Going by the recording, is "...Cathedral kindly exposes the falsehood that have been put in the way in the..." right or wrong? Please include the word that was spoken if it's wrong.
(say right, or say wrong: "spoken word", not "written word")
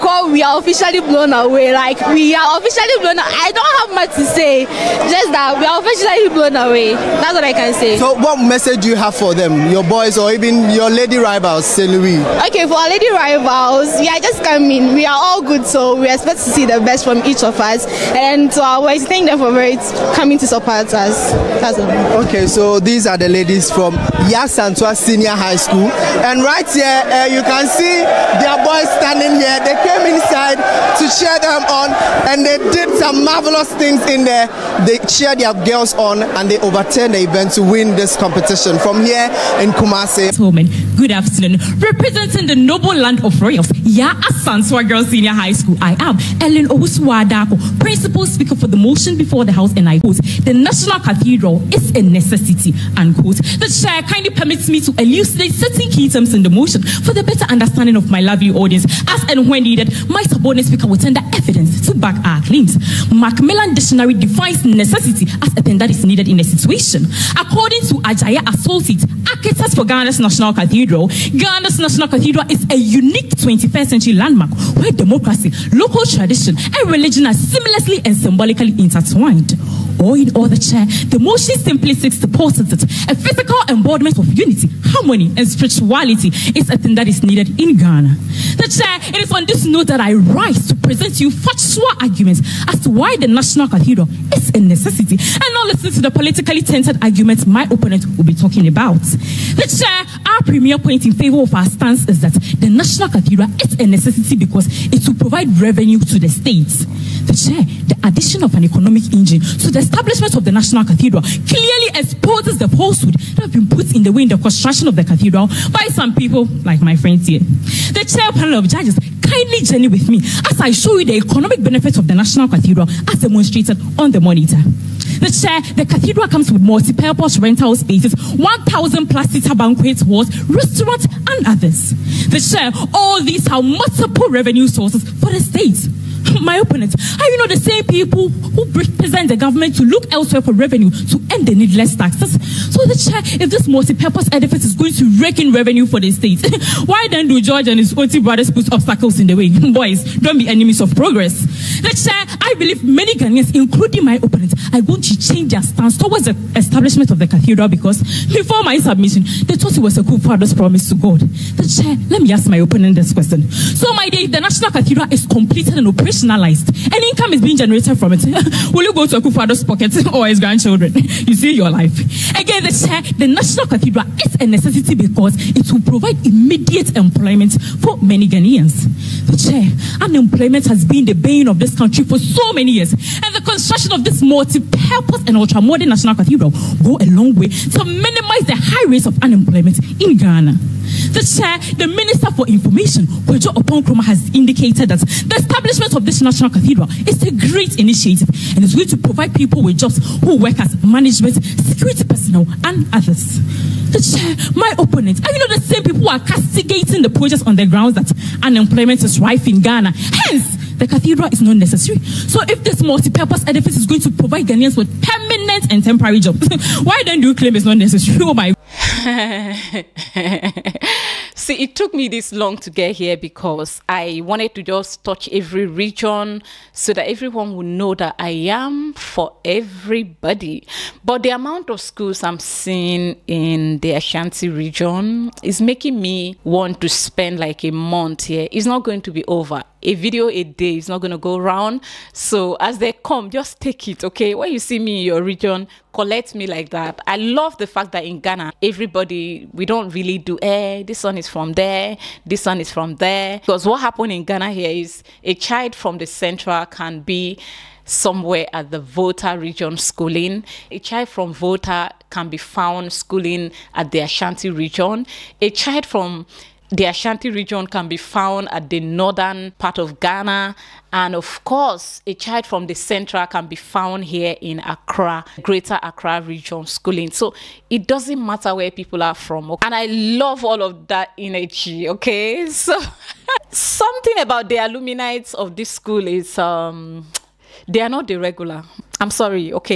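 wrong: "clearly", not "kindly".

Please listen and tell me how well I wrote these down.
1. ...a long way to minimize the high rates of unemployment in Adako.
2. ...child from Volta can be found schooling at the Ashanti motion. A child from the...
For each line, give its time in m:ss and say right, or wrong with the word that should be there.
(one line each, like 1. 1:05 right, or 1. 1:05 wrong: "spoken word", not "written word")
1. 3:07 wrong: "Ghana", not "Adako"
2. 4:20 wrong: "region", not "motion".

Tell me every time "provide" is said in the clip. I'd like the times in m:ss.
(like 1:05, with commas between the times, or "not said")
1:45, 2:55, 3:18, 3:34.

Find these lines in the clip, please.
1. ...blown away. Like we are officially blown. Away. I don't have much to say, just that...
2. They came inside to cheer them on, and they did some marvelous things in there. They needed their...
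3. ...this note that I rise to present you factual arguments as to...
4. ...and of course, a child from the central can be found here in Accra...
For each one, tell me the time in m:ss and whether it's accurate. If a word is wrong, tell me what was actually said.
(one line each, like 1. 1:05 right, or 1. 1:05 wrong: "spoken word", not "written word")
1. 0:00 right
2. 0:29 wrong: "cheered", not "needed"
3. 1:29 right
4. 4:30 right.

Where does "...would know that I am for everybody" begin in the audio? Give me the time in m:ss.
3:47.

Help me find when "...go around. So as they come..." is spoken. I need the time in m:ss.
4:01.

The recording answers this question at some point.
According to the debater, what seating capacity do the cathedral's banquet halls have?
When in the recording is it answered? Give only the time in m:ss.
2:08.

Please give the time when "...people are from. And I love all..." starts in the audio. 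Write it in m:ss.
4:38.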